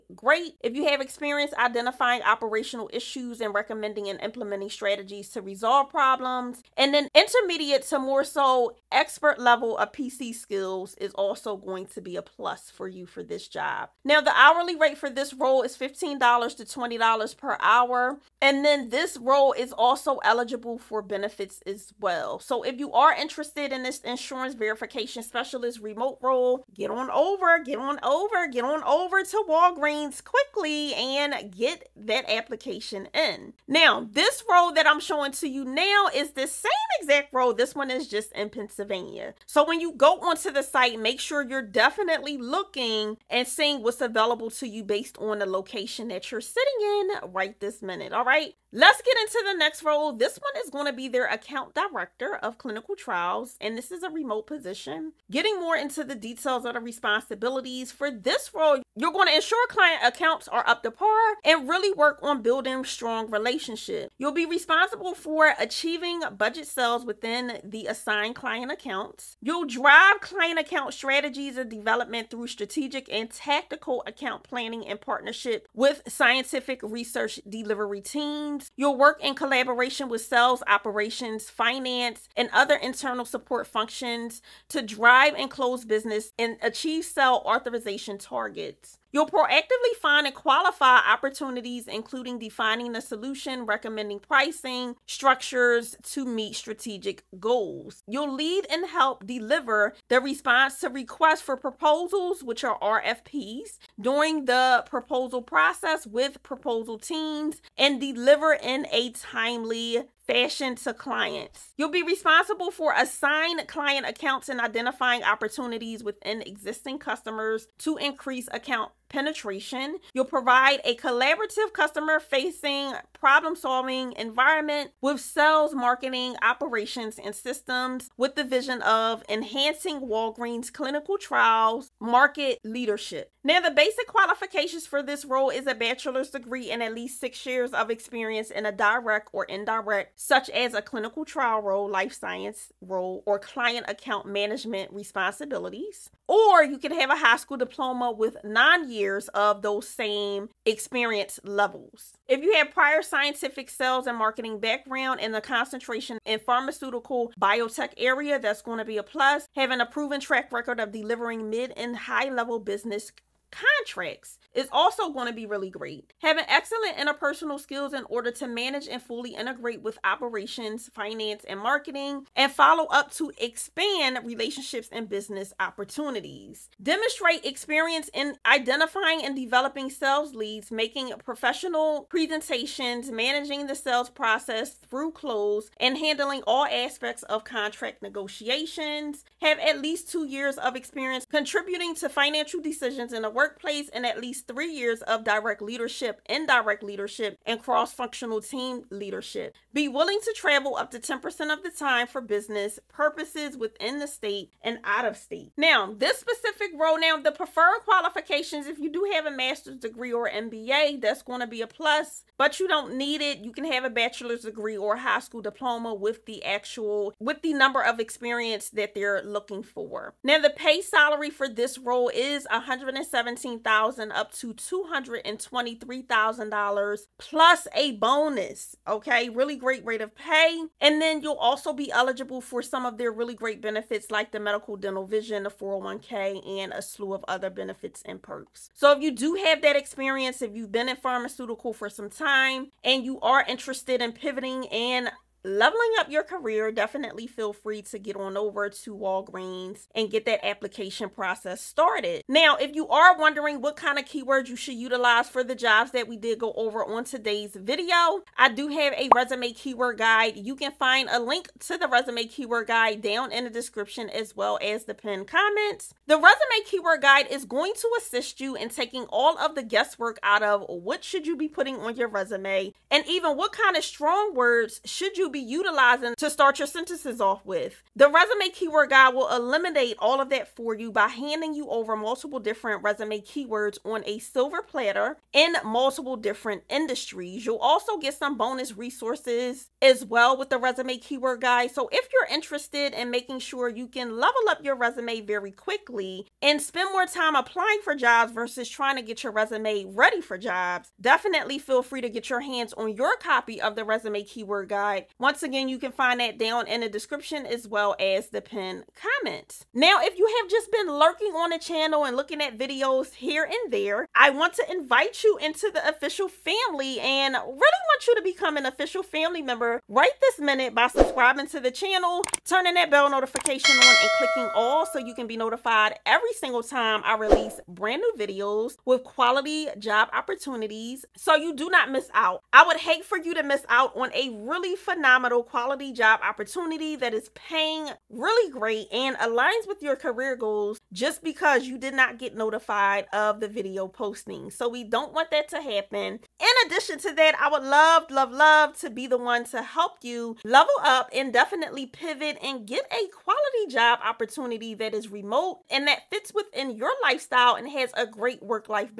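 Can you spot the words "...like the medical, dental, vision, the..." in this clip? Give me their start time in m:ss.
3:54.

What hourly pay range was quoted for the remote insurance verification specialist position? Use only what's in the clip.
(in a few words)
$15 to $20 per hour.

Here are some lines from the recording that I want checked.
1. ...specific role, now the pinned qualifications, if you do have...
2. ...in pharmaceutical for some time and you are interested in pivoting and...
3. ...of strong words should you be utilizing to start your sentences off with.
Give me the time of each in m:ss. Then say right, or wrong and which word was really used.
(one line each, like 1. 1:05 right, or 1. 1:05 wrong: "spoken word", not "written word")
1. 3:26 wrong: "preferred", not "pinned"
2. 4:00 right
3. 4:33 right.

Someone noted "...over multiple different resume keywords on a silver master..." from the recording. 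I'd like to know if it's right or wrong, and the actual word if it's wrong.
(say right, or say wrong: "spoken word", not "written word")
wrong: "platter", not "master".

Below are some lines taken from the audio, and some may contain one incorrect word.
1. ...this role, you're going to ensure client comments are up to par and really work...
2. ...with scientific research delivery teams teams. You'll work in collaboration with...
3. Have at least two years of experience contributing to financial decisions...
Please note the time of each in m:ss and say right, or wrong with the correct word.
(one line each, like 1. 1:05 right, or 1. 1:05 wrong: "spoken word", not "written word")
1. 0:58 wrong: "accounts", not "comments"
2. 1:15 right
3. 3:09 right.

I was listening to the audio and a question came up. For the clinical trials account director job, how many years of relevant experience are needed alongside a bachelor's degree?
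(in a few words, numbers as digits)
6.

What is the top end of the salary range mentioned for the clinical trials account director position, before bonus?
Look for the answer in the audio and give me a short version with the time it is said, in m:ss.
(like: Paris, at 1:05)
$223,000, at 3:44.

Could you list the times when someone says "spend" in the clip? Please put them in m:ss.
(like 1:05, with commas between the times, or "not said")
4:56.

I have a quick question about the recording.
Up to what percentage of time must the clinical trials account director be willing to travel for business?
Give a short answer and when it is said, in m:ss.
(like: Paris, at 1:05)
10%, at 3:20.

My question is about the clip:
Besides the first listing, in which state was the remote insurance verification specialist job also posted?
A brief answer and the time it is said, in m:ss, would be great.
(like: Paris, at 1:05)
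Pennsylvania, at 0:38.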